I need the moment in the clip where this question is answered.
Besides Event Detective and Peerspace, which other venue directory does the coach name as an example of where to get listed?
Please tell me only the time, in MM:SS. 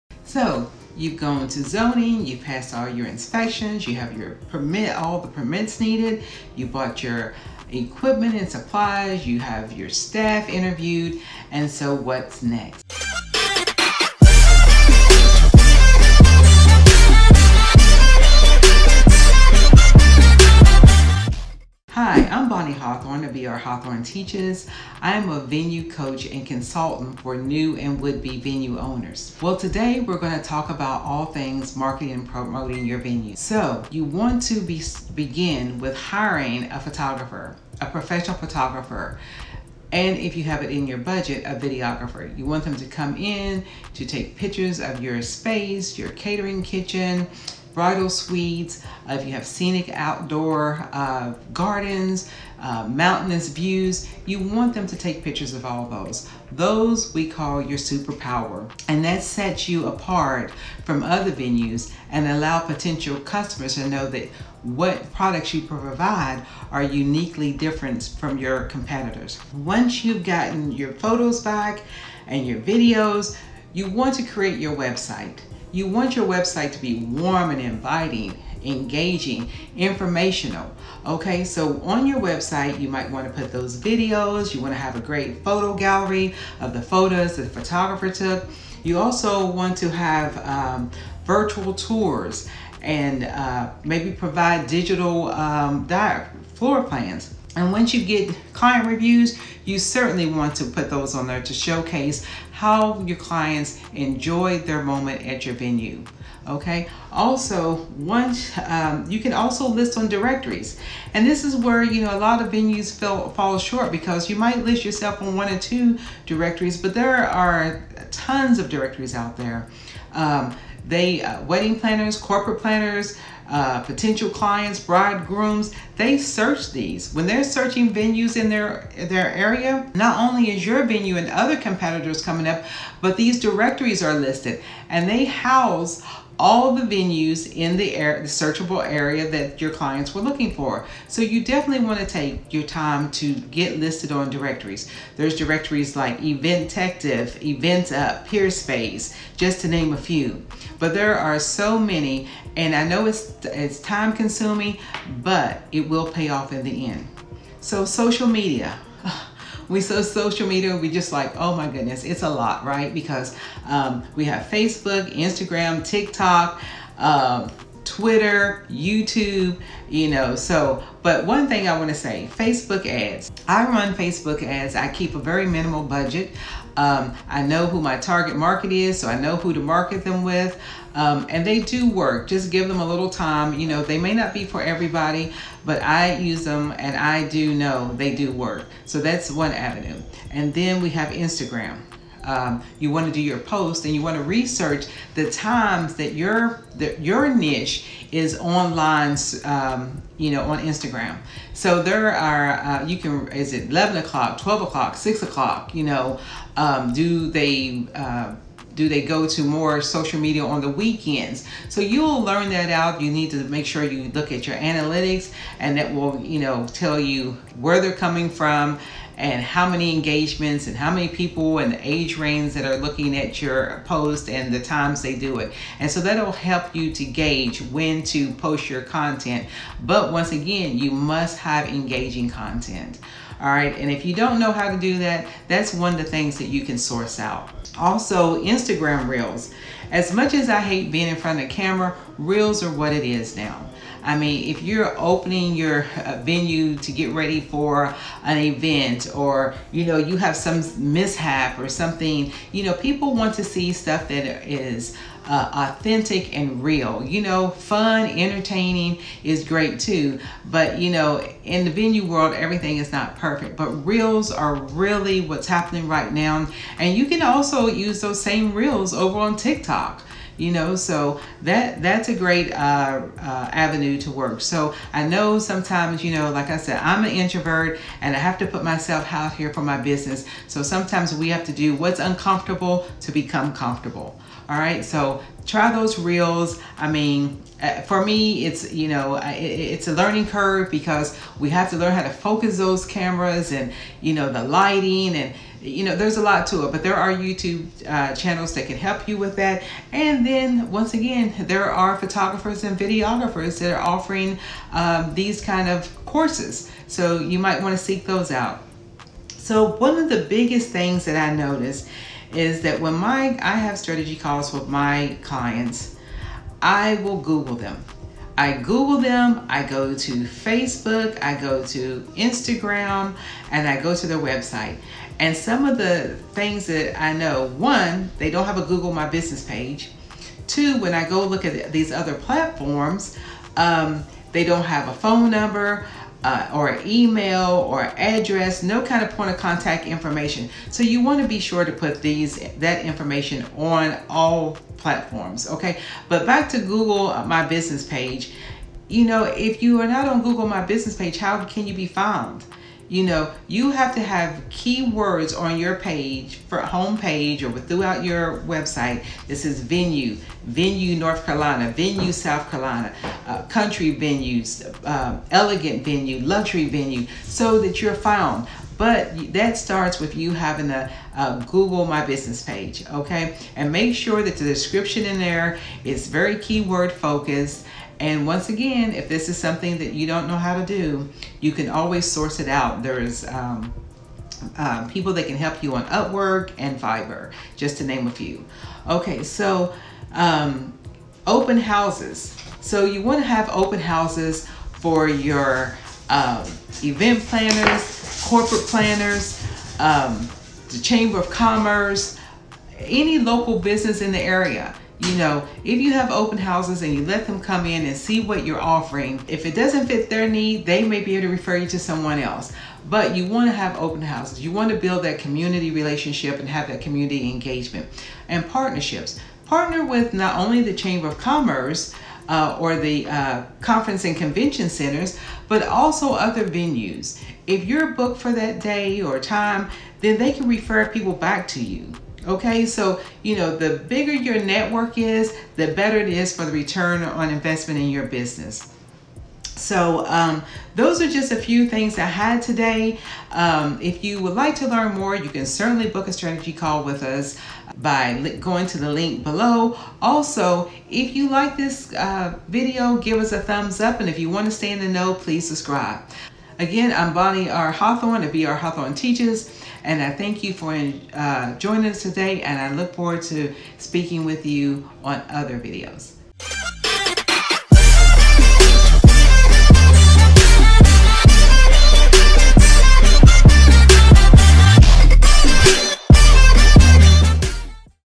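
02:27.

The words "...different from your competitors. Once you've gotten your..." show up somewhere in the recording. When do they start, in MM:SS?
01:07.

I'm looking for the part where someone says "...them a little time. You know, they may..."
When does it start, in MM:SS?
03:02.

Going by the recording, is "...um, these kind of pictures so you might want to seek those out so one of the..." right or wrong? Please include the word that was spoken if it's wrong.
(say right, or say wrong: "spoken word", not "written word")
wrong: "courses", not "pictures".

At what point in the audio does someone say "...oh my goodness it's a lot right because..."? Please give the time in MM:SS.
02:41.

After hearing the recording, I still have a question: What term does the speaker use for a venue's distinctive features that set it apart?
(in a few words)
superpower.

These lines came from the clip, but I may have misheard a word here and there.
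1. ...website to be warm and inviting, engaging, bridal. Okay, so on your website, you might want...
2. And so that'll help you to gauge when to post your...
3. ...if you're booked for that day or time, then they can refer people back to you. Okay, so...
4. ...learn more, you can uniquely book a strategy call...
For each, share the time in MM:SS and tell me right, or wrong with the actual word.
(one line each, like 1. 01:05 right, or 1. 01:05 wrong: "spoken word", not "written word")
1. 01:16 wrong: "informational", not "bridal"
2. 03:45 right
3. 07:07 right
4. 07:24 wrong: "certainly", not "uniquely".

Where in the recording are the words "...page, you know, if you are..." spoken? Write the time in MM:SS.
05:47.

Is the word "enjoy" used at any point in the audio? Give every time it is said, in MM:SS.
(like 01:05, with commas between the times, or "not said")
01:43.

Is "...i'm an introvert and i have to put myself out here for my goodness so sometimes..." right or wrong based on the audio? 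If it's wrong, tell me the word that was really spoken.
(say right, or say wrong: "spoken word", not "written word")
wrong: "business", not "goodness".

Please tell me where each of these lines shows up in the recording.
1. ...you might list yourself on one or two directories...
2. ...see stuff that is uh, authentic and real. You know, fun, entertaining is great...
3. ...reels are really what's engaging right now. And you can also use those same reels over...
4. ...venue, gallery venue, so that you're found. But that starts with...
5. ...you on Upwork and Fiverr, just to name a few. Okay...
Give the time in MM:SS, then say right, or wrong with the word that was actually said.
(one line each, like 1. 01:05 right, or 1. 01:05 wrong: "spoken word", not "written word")
1. 01:54 right
2. 04:13 right
3. 04:23 wrong: "happening", not "engaging"
4. 06:05 wrong: "luxury", not "gallery"
5. 06:25 right.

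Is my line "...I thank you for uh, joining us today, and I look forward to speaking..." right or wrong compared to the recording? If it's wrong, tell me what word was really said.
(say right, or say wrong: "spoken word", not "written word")
right.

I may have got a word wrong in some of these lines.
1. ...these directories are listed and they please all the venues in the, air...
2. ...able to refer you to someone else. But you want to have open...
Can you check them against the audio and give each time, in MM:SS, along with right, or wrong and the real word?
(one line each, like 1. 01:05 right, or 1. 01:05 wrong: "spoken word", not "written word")
1. 02:13 wrong: "house", not "please"
2. 06:51 right.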